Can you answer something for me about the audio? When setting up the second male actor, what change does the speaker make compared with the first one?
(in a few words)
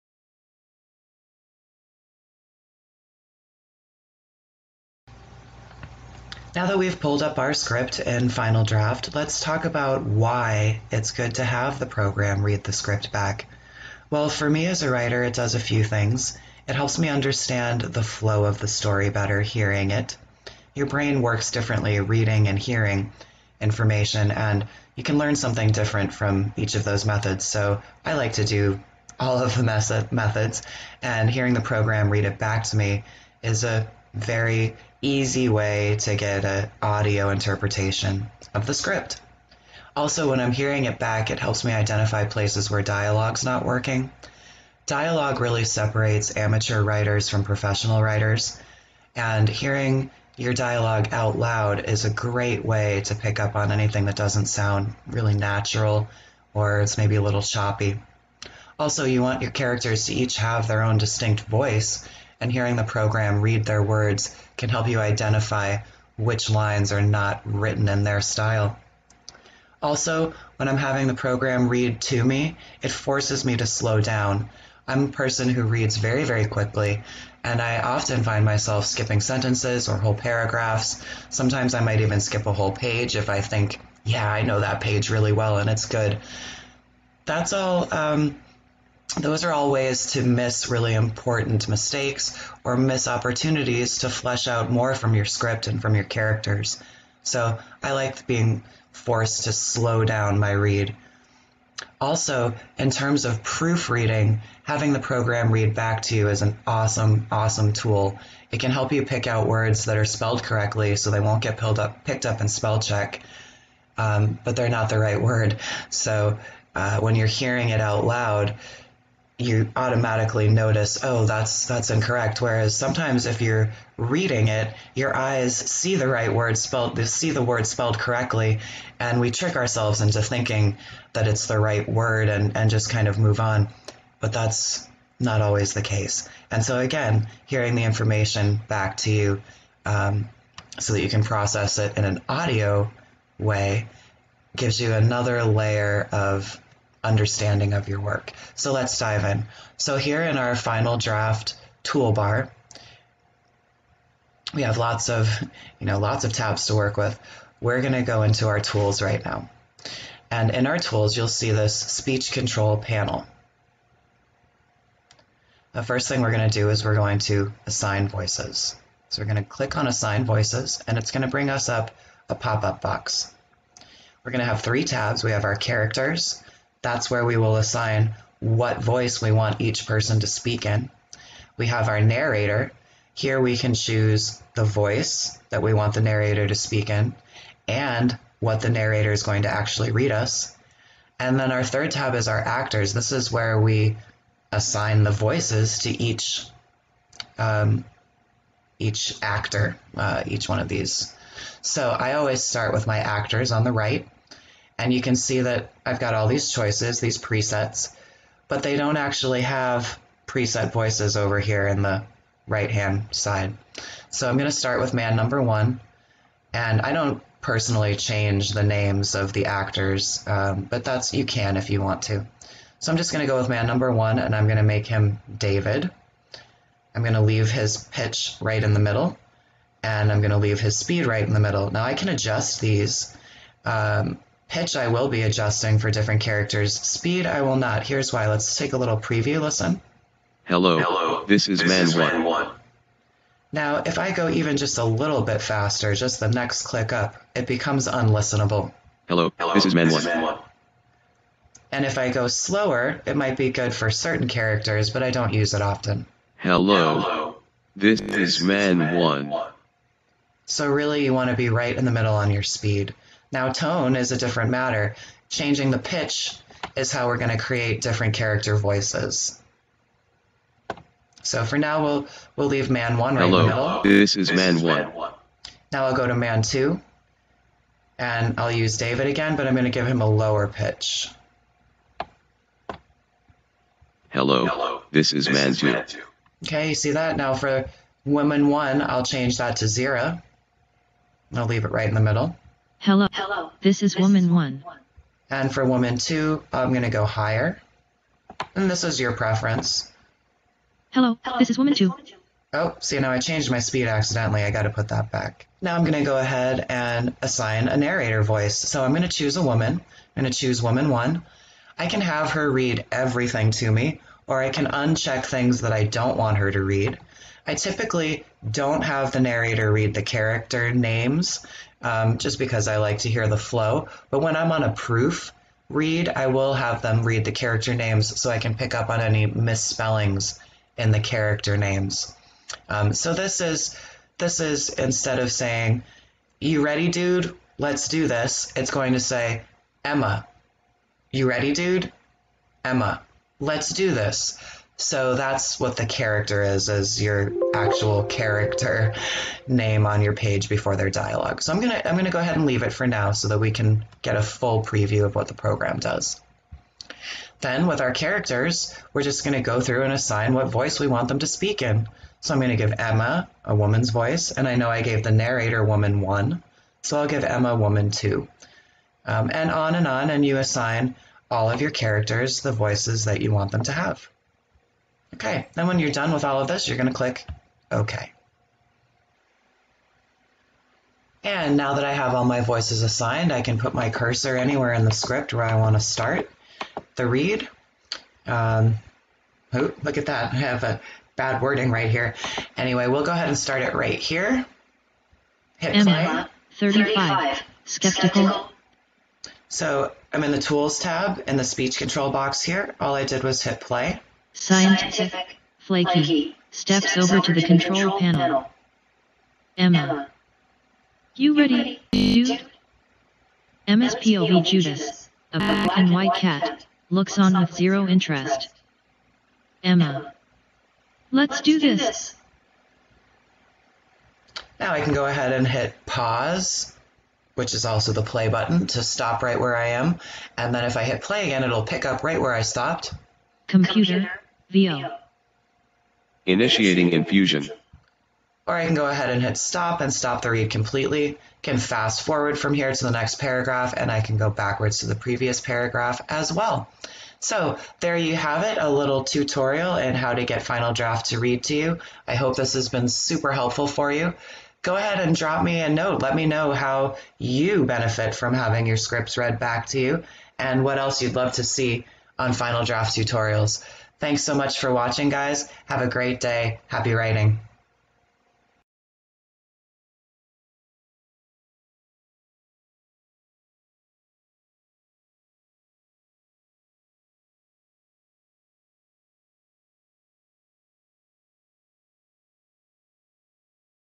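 Lower pitch.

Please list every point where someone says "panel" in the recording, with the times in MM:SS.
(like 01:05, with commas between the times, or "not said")
02:42, 06:47.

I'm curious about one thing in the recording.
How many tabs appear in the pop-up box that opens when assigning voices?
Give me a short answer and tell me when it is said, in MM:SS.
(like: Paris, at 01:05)
3, at 02:54.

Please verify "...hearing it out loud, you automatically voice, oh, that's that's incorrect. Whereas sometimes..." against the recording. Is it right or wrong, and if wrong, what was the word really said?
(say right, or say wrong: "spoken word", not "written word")
wrong: "notice", not "voice".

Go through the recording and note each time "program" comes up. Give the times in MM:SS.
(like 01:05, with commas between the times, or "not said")
00:11, 00:31, 01:02, 01:11, 01:44, 05:55.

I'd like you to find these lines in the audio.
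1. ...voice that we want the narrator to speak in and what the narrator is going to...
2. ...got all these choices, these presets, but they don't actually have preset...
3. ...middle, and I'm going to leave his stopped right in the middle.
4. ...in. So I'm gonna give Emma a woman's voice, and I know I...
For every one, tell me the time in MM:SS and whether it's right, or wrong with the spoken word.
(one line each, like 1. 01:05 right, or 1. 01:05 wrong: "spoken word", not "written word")
1. 03:04 right
2. 03:25 right
3. 03:48 wrong: "speed", not "stopped"
4. 06:01 right.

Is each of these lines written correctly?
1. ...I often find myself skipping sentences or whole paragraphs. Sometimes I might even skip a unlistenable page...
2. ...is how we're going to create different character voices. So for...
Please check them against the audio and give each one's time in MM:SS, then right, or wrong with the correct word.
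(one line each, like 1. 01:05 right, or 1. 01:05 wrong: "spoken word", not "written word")
1. 01:17 wrong: "whole", not "unlistenable"
2. 04:26 right.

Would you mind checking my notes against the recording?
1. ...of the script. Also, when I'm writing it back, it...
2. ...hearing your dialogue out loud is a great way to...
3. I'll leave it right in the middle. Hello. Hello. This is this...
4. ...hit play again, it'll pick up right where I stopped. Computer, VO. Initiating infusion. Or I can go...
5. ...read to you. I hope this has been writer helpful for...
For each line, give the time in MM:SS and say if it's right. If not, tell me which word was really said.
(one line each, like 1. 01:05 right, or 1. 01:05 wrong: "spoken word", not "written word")
1. 00:38 wrong: "hearing", not "writing"
2. 00:49 right
3. 04:51 right
4. 07:10 right
5. 07:31 wrong: "super", not "writer".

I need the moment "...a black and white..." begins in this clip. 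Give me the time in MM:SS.
06:55.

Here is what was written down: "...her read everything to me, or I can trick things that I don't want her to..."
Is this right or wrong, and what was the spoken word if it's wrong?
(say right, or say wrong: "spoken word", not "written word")
wrong: "uncheck", not "trick".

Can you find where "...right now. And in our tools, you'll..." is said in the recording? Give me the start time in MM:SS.
02:39.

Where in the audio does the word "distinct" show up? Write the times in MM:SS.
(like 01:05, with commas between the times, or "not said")
01:00.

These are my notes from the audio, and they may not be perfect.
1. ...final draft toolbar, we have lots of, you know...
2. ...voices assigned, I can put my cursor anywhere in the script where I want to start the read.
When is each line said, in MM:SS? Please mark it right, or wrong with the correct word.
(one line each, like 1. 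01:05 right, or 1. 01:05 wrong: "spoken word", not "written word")
1. 02:30 right
2. 06:22 right.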